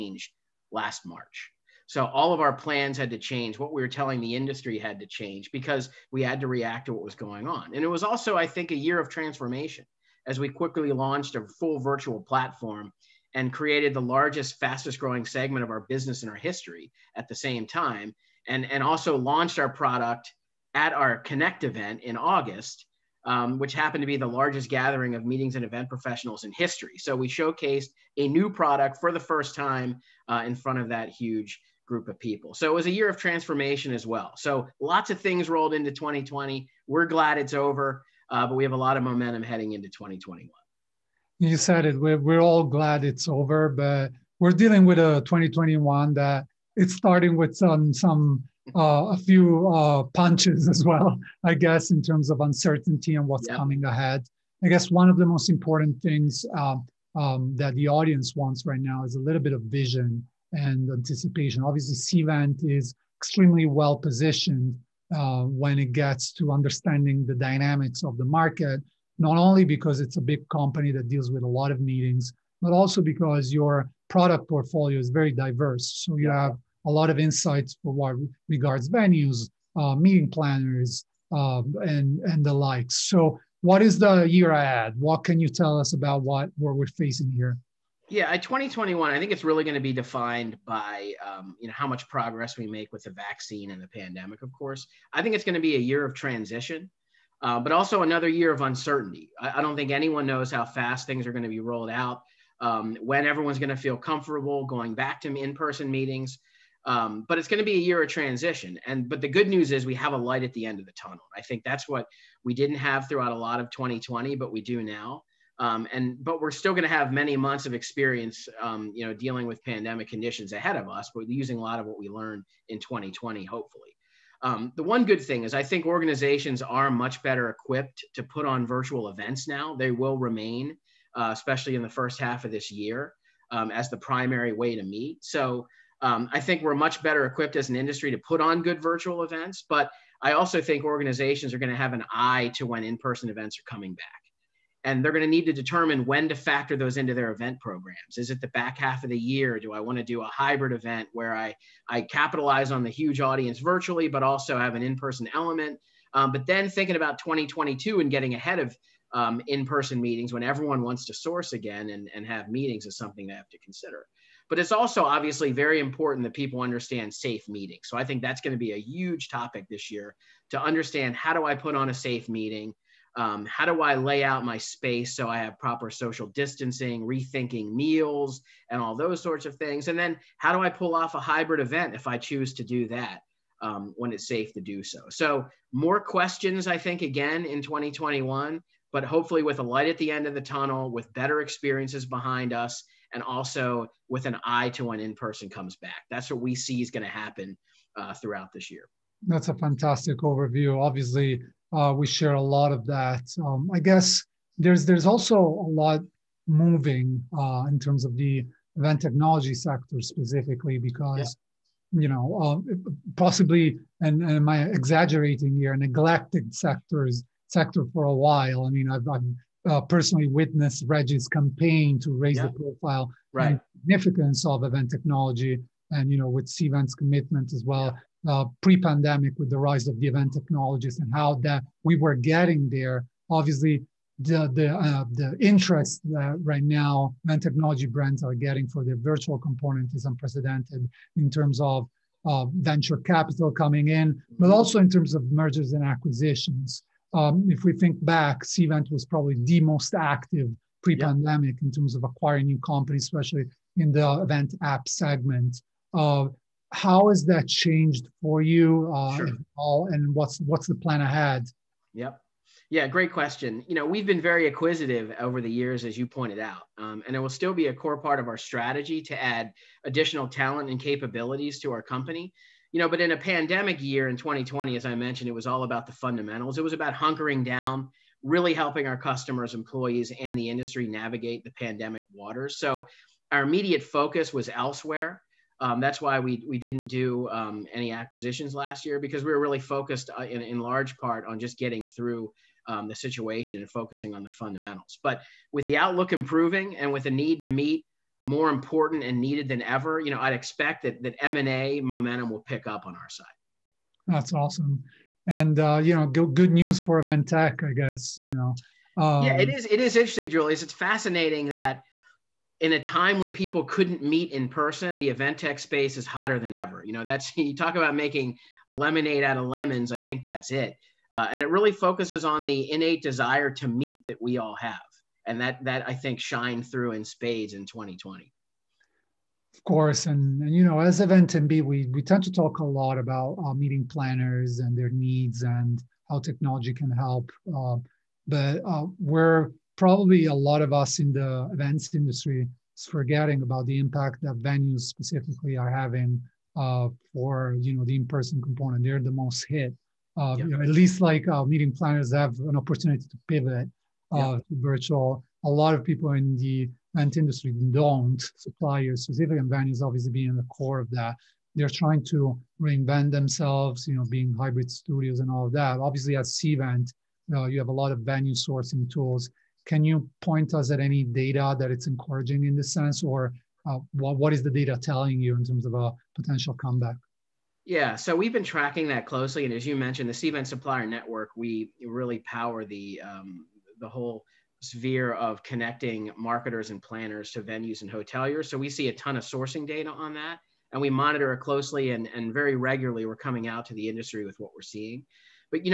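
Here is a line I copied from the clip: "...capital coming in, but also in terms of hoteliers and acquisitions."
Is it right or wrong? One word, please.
wrong.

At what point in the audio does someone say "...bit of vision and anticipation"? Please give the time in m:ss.
0:59.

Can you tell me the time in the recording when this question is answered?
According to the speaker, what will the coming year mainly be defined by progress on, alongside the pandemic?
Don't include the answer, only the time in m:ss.
1:33.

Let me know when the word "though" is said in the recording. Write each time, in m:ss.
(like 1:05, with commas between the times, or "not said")
not said.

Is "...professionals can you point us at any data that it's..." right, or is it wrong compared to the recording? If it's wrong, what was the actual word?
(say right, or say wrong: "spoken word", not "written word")
wrong: "tools", not "professionals".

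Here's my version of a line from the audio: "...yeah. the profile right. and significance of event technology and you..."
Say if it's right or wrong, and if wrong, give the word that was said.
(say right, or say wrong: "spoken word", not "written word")
right.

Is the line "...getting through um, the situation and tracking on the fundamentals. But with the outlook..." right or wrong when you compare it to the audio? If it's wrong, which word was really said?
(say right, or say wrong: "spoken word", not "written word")
wrong: "focusing", not "tracking".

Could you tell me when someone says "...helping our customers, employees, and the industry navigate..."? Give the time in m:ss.
4:38.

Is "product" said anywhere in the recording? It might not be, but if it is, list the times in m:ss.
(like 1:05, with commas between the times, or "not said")
0:19, 0:28, 1:14.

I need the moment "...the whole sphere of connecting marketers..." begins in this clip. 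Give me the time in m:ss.
6:23.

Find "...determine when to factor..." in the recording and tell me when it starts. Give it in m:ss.
2:25.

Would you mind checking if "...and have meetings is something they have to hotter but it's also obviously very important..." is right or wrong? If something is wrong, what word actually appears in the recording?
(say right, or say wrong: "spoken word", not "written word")
wrong: "consider", not "hotter".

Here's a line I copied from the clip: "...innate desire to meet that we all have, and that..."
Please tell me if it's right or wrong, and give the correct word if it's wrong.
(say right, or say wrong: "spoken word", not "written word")
right.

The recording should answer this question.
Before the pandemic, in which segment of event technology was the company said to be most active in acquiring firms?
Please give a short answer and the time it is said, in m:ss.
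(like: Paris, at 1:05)
event app segment, at 4:14.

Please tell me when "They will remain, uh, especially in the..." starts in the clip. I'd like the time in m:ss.
2:09.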